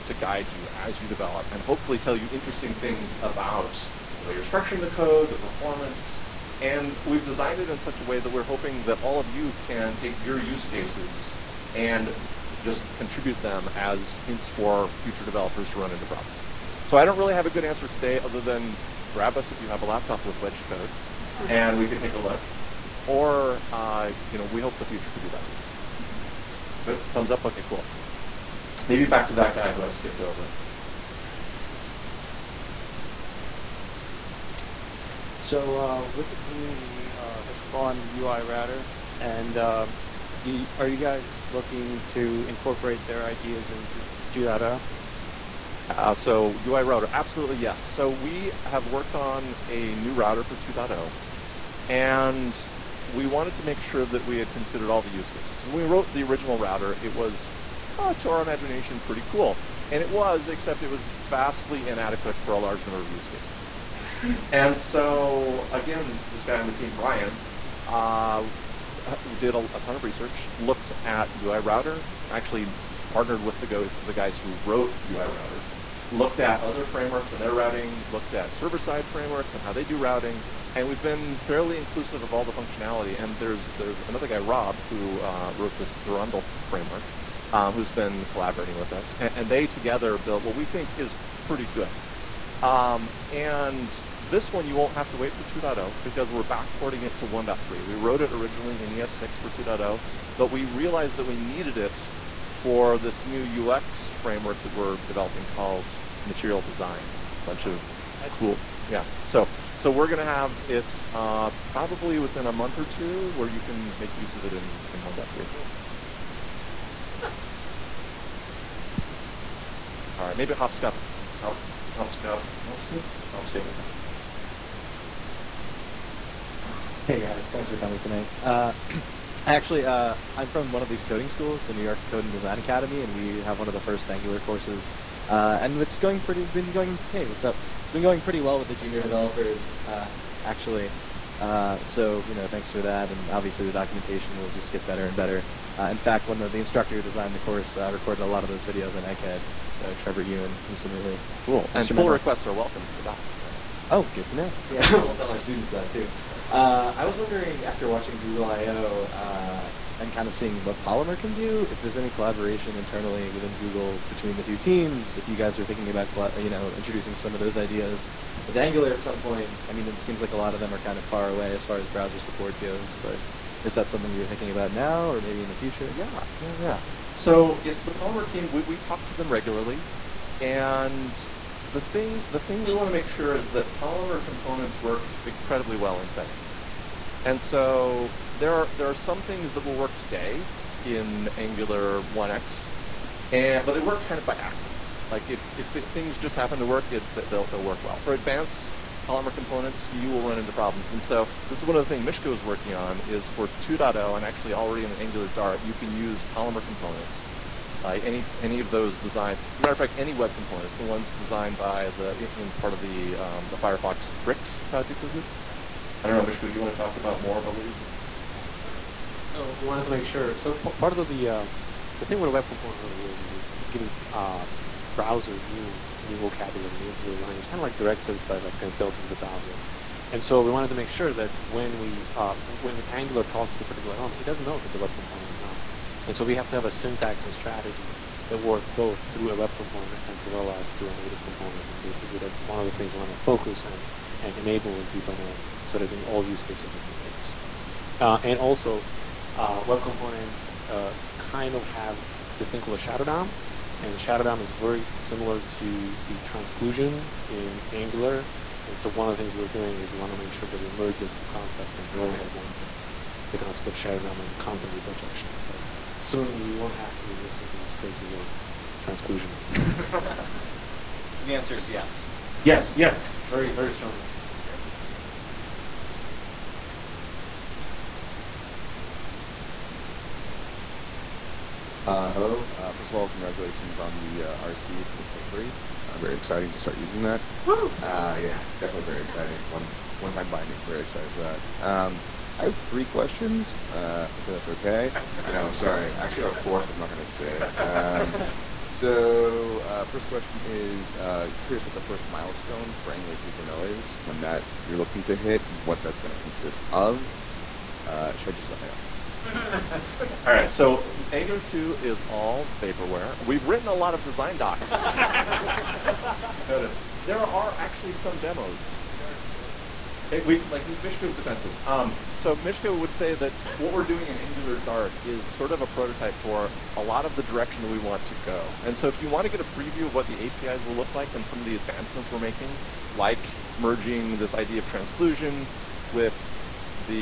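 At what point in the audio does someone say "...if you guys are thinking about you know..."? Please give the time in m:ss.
2:45.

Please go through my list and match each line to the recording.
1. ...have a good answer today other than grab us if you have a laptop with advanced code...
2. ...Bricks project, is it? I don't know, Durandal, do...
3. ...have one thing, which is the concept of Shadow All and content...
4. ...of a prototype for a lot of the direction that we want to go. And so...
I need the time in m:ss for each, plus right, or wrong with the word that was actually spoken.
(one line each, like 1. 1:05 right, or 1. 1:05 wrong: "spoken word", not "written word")
1. 0:17 wrong: "wedged", not "advanced"
2. 3:34 wrong: "Misko", not "Durandal"
3. 4:22 wrong: "DOM", not "All"
4. 5:25 right.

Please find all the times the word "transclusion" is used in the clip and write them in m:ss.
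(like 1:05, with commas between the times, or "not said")
4:16, 4:28, 5:34.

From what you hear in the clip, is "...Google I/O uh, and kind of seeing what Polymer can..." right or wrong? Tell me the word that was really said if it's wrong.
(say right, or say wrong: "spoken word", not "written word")
right.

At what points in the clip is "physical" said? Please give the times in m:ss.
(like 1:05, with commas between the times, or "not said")
not said.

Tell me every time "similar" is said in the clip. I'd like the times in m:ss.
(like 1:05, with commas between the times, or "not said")
4:14.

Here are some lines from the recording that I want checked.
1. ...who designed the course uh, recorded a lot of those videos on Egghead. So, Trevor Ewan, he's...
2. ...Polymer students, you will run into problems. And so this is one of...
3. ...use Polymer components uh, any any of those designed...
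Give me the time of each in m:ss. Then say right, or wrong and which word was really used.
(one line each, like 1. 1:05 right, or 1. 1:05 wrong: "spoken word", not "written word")
1. 2:26 right
2. 3:19 wrong: "components", not "students"
3. 3:25 right.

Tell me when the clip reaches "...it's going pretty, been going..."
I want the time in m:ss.
2:15.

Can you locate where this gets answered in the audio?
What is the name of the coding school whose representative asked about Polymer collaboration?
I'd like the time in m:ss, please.
2:11.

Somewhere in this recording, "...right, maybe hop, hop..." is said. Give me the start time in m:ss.
2:00.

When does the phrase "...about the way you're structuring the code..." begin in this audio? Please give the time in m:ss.
0:03.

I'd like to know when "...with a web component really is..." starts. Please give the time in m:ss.
3:42.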